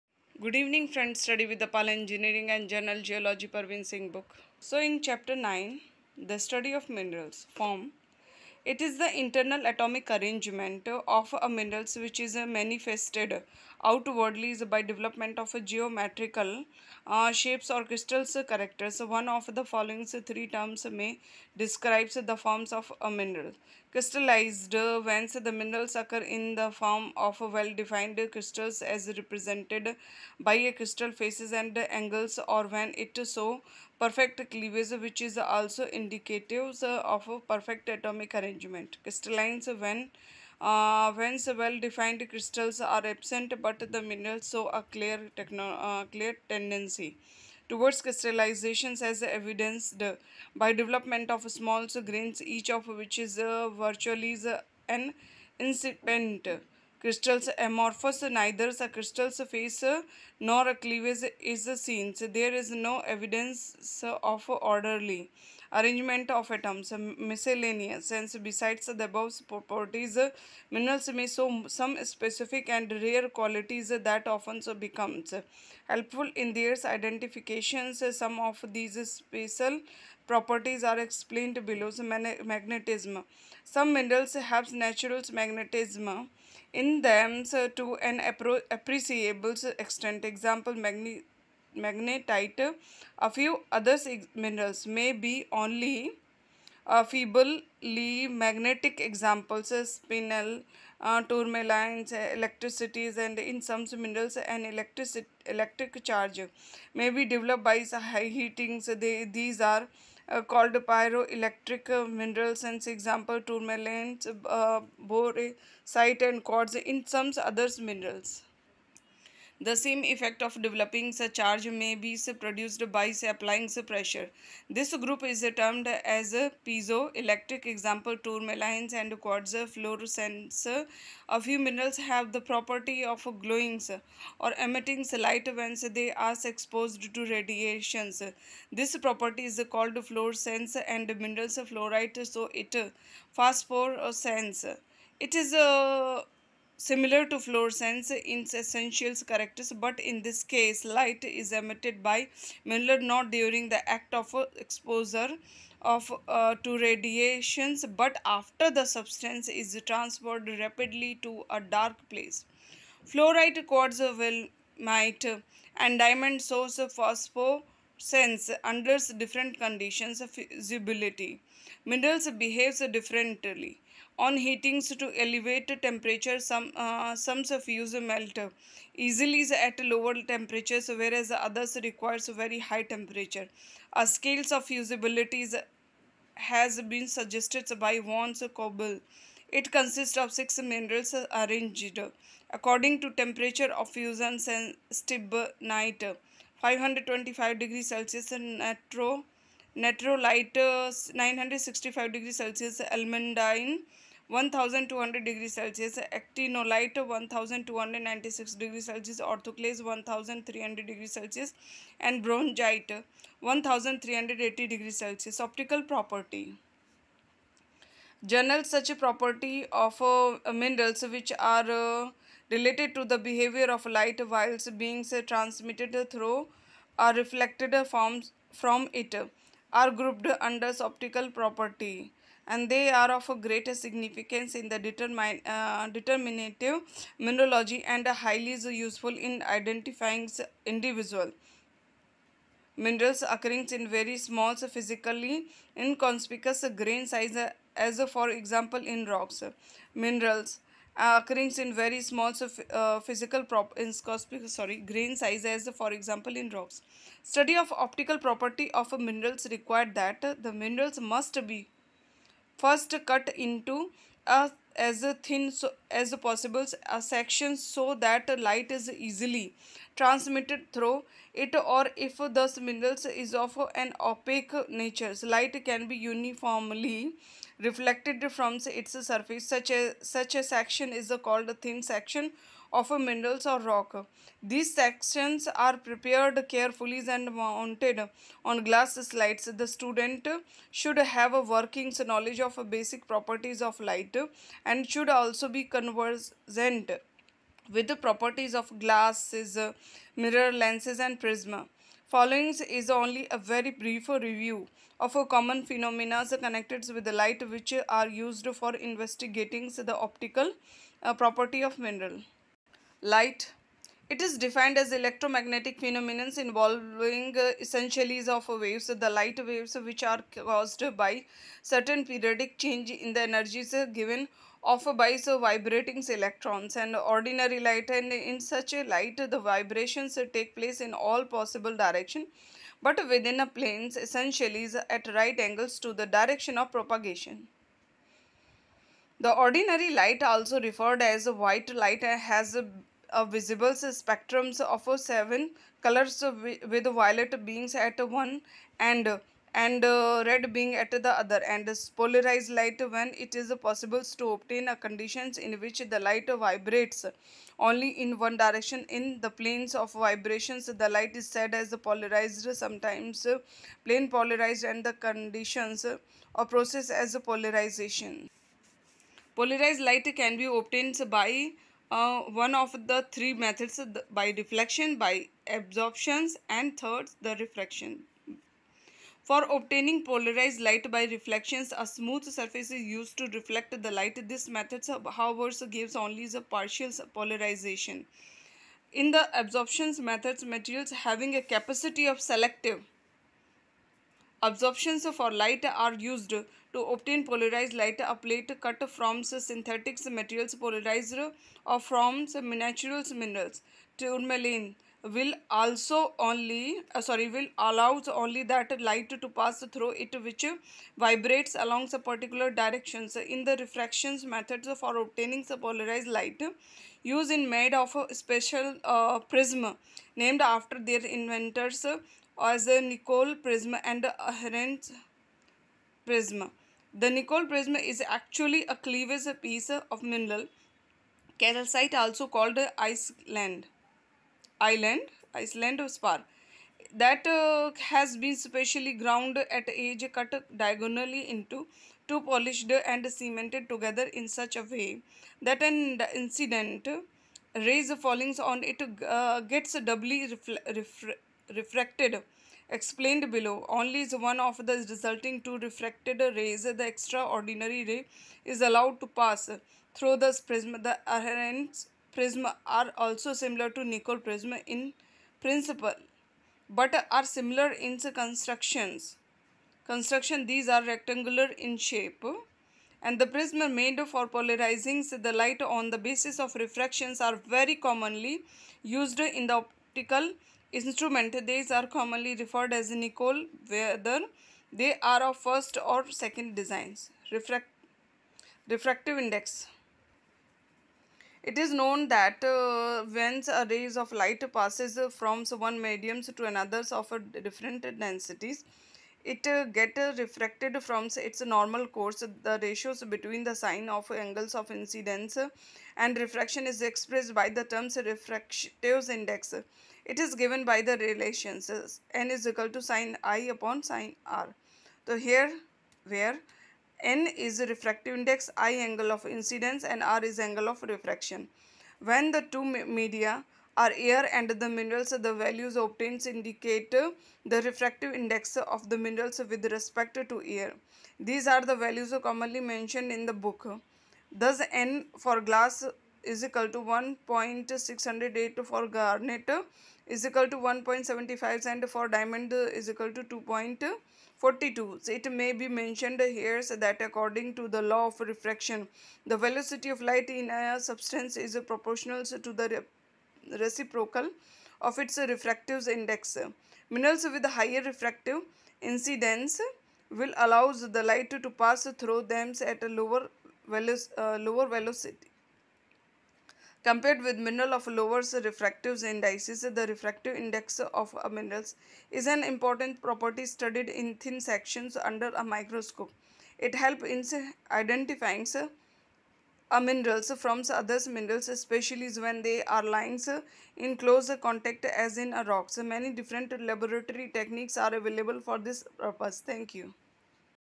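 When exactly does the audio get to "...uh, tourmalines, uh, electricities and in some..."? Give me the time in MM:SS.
01:40.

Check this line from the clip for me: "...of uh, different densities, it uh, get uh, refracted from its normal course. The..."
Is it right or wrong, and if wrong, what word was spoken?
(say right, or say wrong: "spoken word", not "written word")
right.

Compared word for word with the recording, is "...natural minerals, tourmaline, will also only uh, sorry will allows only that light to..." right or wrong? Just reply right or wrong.
right.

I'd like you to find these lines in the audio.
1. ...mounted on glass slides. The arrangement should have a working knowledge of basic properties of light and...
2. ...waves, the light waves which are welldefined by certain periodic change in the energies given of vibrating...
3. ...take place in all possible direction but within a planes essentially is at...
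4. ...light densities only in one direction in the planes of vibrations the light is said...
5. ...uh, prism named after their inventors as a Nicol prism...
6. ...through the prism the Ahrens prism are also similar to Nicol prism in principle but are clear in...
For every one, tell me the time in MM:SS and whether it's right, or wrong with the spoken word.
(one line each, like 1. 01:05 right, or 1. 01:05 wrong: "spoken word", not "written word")
1. 04:47 wrong: "student", not "arrangement"
2. 05:18 wrong: "caused", not "welldefined"
3. 05:30 right
4. 05:55 wrong: "vibrates", not "densities"
5. 06:58 right
6. 07:39 wrong: "similar", not "clear".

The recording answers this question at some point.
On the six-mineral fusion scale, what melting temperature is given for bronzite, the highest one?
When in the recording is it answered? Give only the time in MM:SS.
03:32.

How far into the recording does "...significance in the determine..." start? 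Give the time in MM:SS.
03:53.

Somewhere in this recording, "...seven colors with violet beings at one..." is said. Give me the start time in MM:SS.
05:44.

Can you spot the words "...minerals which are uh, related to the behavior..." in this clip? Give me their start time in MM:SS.
03:40.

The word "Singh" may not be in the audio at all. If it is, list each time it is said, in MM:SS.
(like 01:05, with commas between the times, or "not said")
00:03.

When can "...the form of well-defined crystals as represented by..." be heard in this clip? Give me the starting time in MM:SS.
00:26.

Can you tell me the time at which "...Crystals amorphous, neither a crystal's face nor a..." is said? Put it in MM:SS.
00:57.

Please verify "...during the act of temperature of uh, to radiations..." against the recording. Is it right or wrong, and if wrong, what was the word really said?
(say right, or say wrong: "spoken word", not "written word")
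wrong: "exposure", not "temperature".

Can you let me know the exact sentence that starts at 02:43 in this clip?
Fluorite quartz might and diamond source phosphorescence under different conditions of visibility.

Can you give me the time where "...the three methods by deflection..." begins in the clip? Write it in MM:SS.
06:12.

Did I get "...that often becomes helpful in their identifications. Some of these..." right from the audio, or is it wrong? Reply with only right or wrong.
right.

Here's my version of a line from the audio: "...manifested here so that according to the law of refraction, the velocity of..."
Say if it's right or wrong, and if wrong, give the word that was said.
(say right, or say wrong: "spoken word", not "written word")
wrong: "mentioned", not "manifested".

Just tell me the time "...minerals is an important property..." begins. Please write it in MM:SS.
09:31.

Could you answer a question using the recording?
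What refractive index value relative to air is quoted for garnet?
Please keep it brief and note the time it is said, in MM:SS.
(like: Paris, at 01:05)
1.75, at 09:00.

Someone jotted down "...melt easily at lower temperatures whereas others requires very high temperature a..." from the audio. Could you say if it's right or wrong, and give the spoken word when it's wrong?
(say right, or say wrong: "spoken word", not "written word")
right.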